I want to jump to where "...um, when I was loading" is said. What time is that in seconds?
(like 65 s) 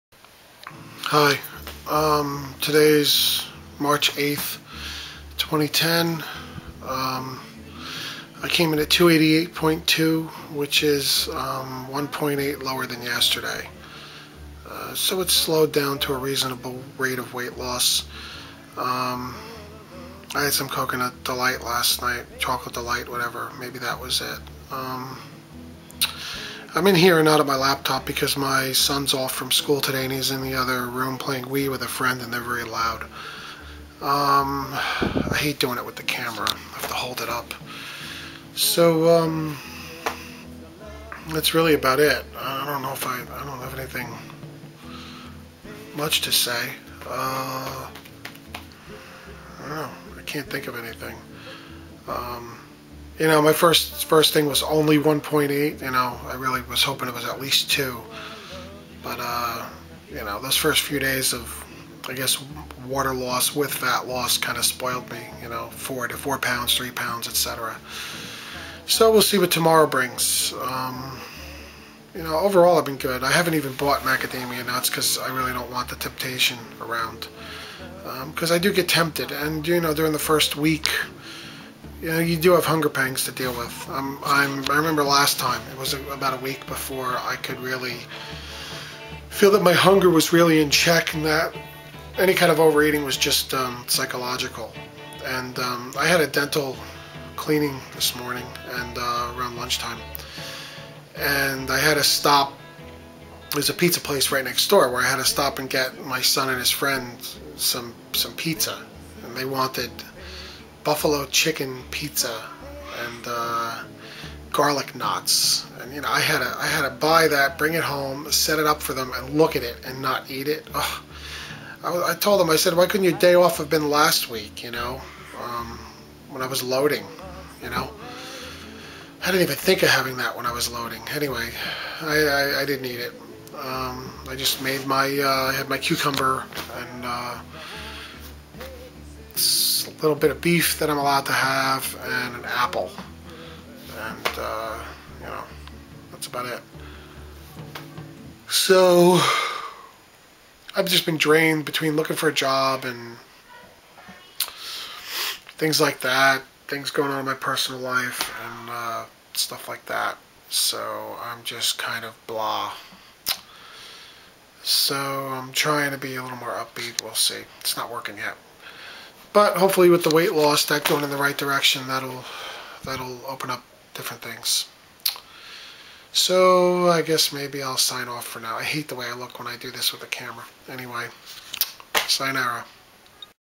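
125 s.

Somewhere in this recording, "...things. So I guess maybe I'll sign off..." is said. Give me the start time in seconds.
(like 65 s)
174 s.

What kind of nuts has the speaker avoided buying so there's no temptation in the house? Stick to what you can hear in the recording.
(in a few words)
macadamia nuts.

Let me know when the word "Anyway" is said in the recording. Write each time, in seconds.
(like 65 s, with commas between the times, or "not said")
131 s, 180 s.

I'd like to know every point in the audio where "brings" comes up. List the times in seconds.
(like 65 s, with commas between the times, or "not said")
69 s, 117 s.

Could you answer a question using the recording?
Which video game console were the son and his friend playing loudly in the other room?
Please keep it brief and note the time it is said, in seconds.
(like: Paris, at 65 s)
Wii, at 31 s.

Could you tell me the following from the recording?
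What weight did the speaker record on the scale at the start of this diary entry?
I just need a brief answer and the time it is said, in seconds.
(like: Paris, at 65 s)
288.2, at 8 s.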